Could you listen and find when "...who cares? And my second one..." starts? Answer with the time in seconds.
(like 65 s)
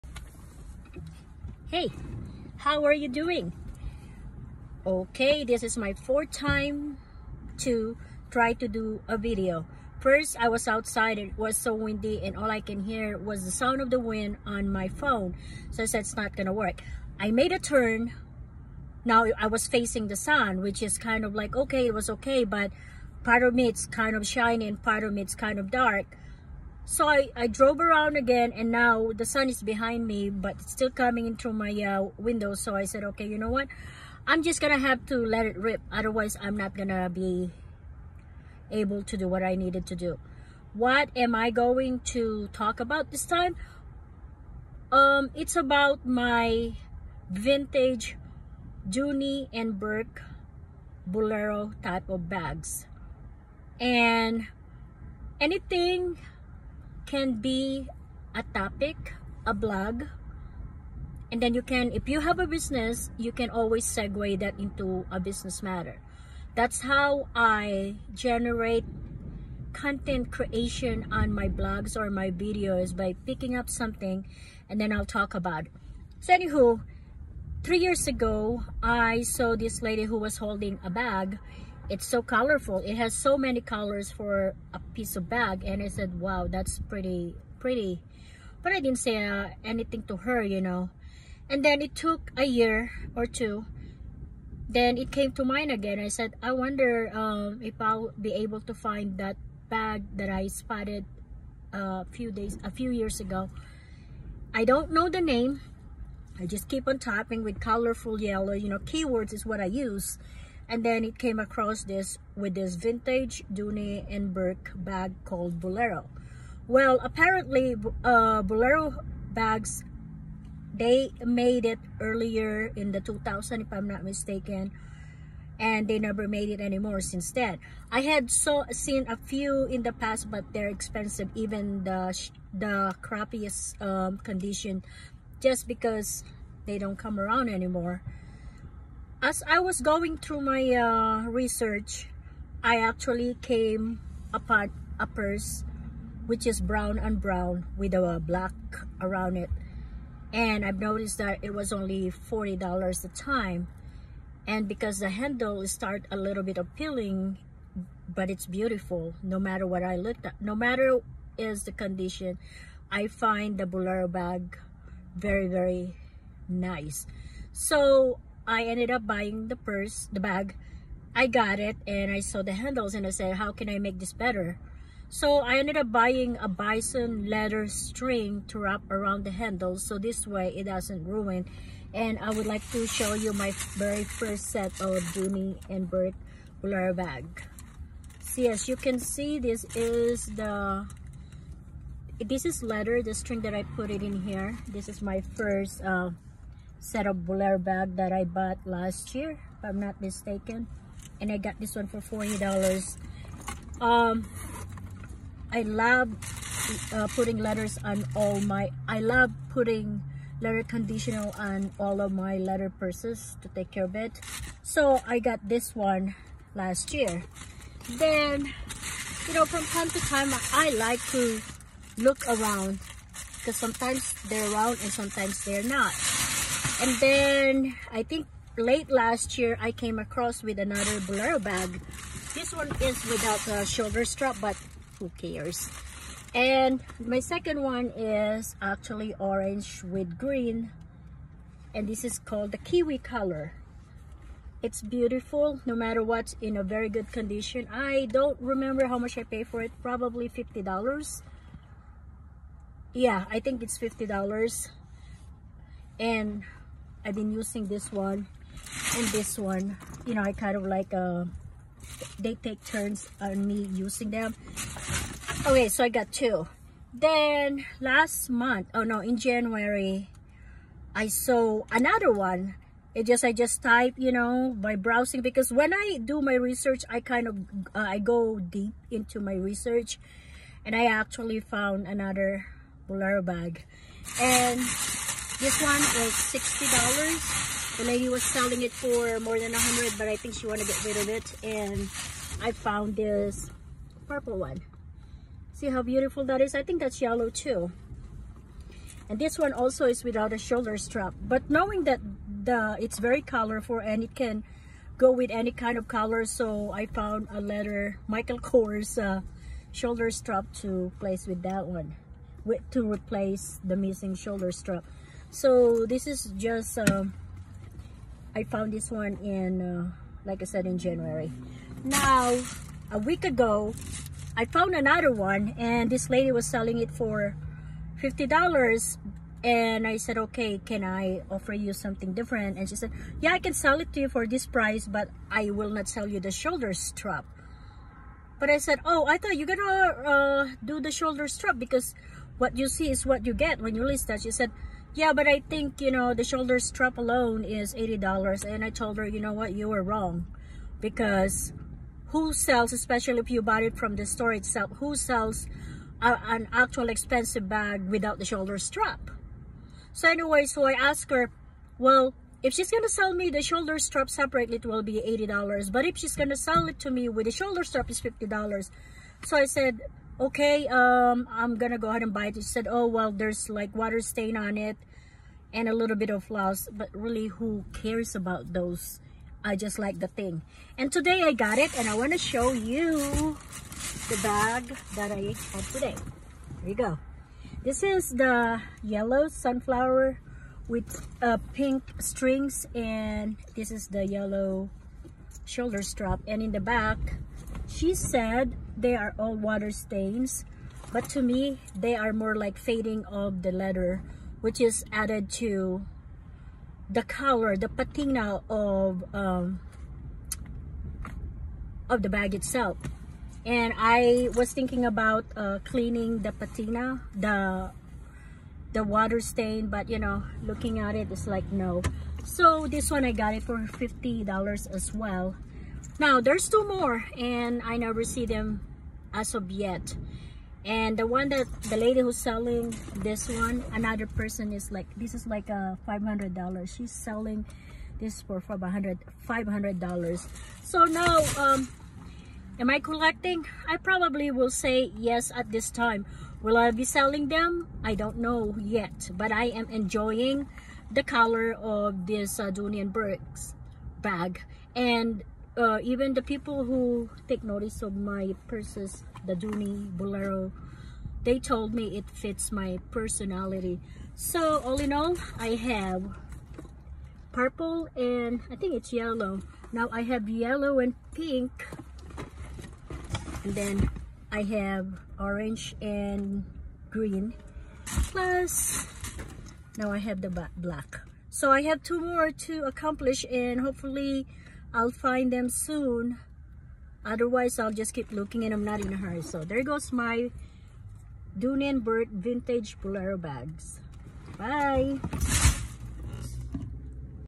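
234 s.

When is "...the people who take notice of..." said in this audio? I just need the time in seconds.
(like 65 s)
456 s.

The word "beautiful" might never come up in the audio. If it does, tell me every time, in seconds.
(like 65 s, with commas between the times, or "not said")
158 s, 244 s, 295 s.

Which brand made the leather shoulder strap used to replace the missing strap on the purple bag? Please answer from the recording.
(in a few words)
Michael Kors.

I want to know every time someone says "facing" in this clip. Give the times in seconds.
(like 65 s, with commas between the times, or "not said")
19 s.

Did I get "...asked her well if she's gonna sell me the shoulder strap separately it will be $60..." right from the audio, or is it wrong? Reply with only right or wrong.
wrong.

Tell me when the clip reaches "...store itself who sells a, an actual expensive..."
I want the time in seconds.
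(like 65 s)
354 s.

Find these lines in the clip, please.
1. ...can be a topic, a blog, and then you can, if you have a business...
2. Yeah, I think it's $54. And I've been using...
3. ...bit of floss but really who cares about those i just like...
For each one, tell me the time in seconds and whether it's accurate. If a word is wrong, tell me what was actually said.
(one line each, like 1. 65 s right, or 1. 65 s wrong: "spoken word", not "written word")
1. 57 s right
2. 252 s wrong: "50", not "54"
3. 375 s right.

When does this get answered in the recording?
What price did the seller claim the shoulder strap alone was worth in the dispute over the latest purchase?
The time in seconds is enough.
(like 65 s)
346 s.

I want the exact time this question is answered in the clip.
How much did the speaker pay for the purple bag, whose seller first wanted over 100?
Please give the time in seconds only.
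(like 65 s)
285 s.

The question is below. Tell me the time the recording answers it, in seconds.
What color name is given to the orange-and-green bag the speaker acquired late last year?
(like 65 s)
242 s.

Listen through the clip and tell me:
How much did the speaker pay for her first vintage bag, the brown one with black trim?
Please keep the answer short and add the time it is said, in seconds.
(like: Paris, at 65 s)
$40, at 151 s.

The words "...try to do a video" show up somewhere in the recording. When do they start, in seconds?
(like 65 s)
8 s.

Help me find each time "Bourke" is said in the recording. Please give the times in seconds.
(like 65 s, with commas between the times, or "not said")
49 s, 114 s, 185 s, 452 s, 491 s.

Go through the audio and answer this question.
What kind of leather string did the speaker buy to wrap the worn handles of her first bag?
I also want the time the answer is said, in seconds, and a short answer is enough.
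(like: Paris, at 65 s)
bison leather, at 176 s.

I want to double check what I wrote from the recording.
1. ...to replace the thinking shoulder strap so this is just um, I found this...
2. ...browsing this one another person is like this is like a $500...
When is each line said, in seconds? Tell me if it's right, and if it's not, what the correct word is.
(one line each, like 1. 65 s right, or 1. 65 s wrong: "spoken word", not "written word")
1. 312 s wrong: "missing", not "thinking"
2. 432 s wrong: "selling", not "browsing".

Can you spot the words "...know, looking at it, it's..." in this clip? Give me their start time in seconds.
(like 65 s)
419 s.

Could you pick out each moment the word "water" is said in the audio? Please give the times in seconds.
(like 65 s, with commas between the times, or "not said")
373 s, 399 s, 418 s.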